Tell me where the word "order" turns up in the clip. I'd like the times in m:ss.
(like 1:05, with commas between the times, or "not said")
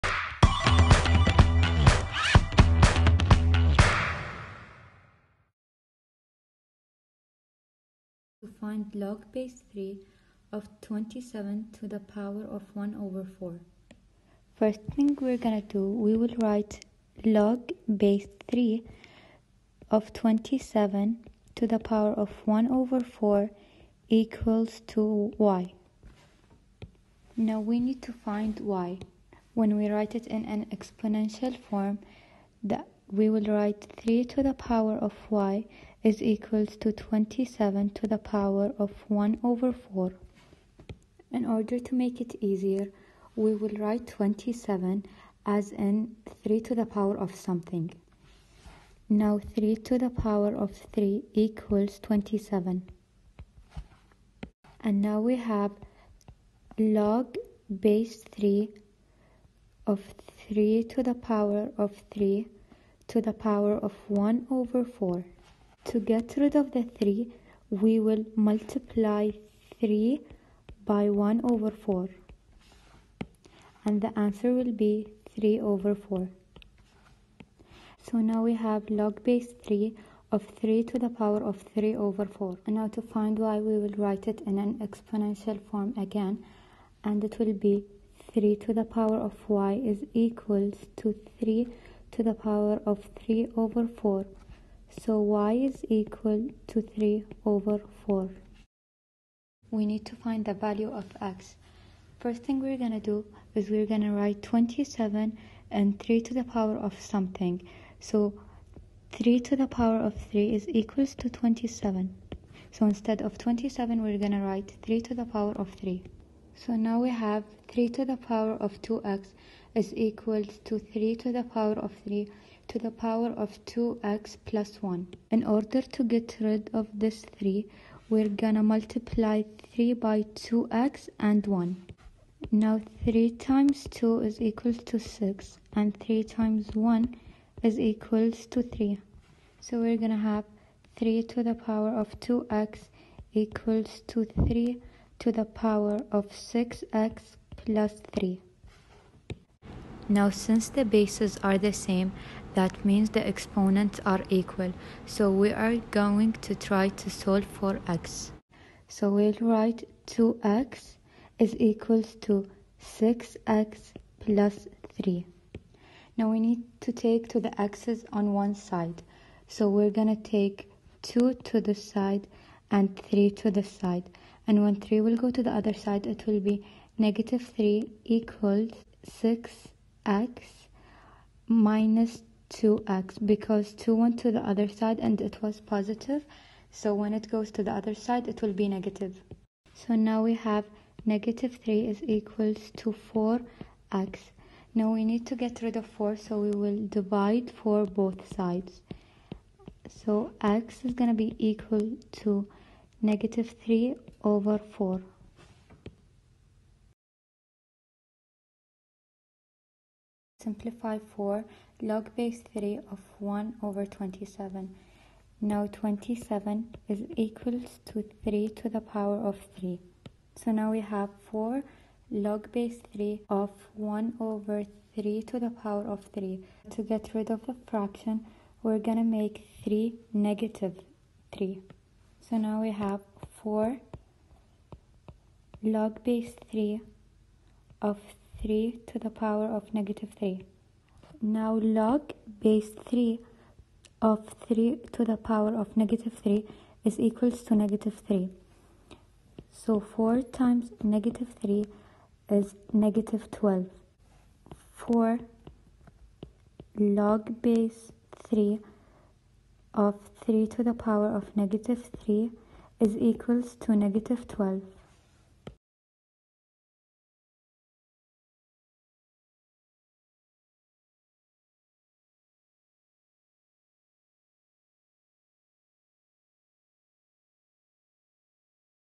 0:41, 2:05.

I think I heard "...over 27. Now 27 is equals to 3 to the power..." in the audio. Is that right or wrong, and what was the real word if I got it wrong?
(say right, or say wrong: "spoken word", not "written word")
right.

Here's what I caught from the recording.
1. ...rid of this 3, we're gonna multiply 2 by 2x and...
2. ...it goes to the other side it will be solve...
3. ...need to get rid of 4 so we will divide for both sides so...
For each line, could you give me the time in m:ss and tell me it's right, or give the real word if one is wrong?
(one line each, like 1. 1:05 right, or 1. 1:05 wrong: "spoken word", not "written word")
1. 2:06 wrong: "3", not "2"
2. 3:07 wrong: "negative", not "solve"
3. 3:15 right.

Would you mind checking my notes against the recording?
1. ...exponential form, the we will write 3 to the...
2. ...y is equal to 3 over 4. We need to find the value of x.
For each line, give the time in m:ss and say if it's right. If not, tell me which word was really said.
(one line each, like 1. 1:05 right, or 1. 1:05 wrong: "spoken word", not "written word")
1. 0:30 right
2. 1:35 right.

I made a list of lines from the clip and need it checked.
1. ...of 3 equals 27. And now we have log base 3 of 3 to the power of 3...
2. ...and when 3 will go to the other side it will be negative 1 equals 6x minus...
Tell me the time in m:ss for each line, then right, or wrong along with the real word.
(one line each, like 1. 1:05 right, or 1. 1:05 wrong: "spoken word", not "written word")
1. 0:50 right
2. 2:54 wrong: "3", not "1".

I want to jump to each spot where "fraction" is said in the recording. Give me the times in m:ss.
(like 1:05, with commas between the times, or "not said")
3:47.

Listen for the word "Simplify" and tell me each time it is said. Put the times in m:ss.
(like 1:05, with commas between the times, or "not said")
3:30.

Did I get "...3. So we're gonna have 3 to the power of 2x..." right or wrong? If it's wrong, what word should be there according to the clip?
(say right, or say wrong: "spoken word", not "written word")
right.